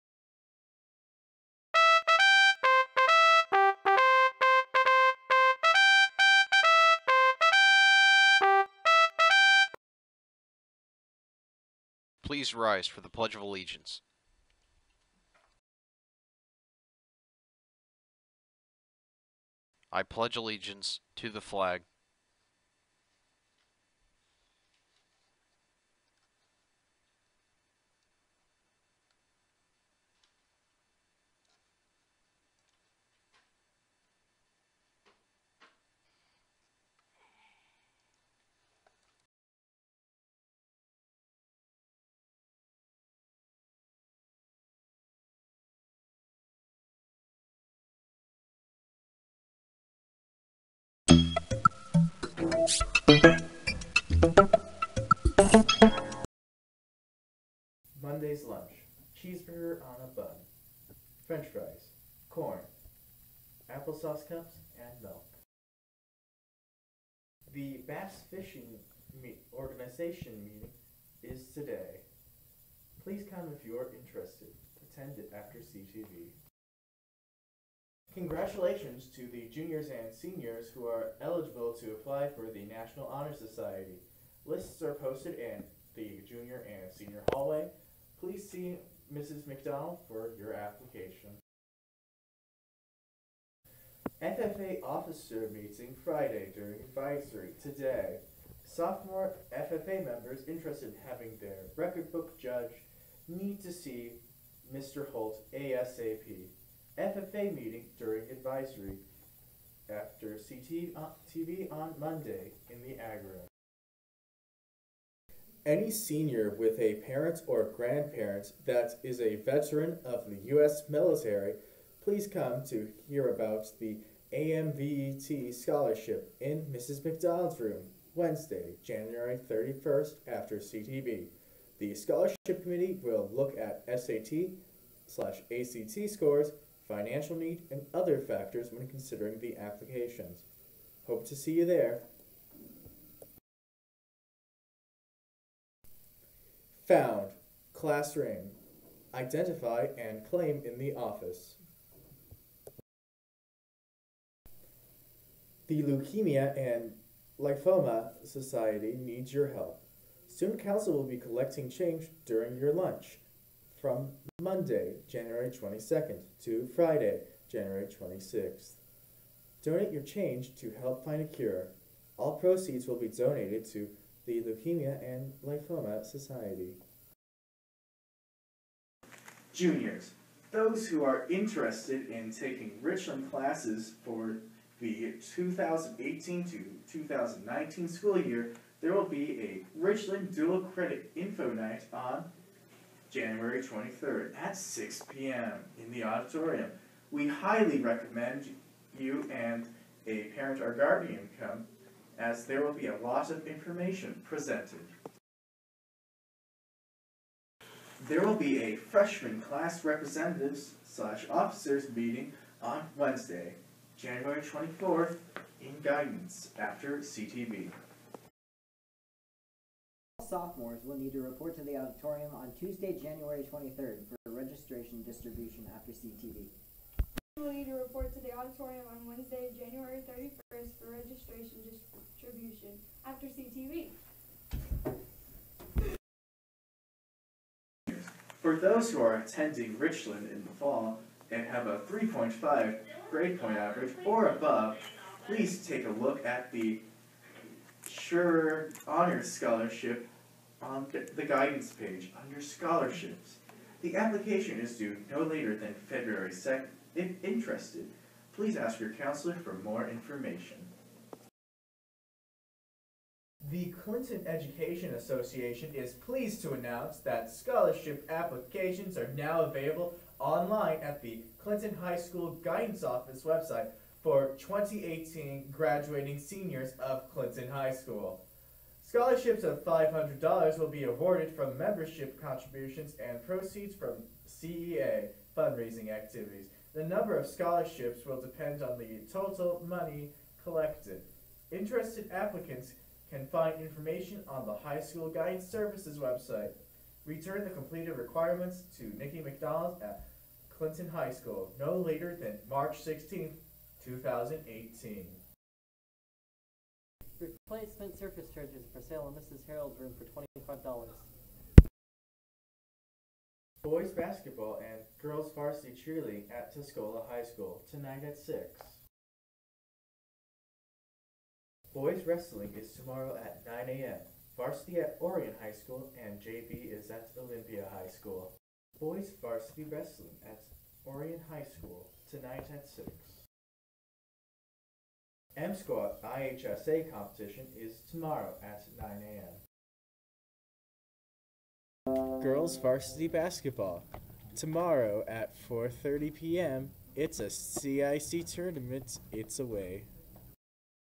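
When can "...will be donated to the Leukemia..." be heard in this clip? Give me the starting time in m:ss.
2:52.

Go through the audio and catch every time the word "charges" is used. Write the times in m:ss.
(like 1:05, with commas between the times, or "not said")
5:08.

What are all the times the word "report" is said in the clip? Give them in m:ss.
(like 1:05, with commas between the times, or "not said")
3:41, 3:47.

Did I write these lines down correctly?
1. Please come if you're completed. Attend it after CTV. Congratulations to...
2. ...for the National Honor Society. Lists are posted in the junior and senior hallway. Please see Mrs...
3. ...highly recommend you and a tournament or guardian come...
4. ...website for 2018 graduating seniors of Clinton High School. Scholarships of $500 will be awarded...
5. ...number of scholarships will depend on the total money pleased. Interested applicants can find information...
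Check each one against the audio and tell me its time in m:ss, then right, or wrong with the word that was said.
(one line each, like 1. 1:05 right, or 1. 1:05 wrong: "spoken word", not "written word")
1. 1:13 wrong: "interested", not "completed"
2. 1:22 right
3. 3:17 wrong: "parent", not "tournament"
4. 4:33 right
5. 4:46 wrong: "collected", not "pleased".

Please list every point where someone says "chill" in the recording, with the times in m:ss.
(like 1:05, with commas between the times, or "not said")
not said.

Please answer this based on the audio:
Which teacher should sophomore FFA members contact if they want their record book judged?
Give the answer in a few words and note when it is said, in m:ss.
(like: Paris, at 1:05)
Mr. Holt, at 1:44.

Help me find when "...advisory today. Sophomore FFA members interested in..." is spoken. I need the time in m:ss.
1:36.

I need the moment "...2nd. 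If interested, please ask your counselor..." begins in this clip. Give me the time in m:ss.
4:16.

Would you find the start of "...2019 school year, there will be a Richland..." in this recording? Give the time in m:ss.
3:06.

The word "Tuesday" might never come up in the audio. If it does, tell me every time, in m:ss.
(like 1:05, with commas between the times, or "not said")
3:42.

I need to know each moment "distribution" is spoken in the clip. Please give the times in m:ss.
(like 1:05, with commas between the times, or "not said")
3:45, 3:52.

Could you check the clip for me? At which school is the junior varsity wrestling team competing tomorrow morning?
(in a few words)
Olympia High School.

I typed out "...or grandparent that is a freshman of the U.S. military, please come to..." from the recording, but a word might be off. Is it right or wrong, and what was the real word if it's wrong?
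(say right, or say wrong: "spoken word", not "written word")
wrong: "veteran", not "freshman".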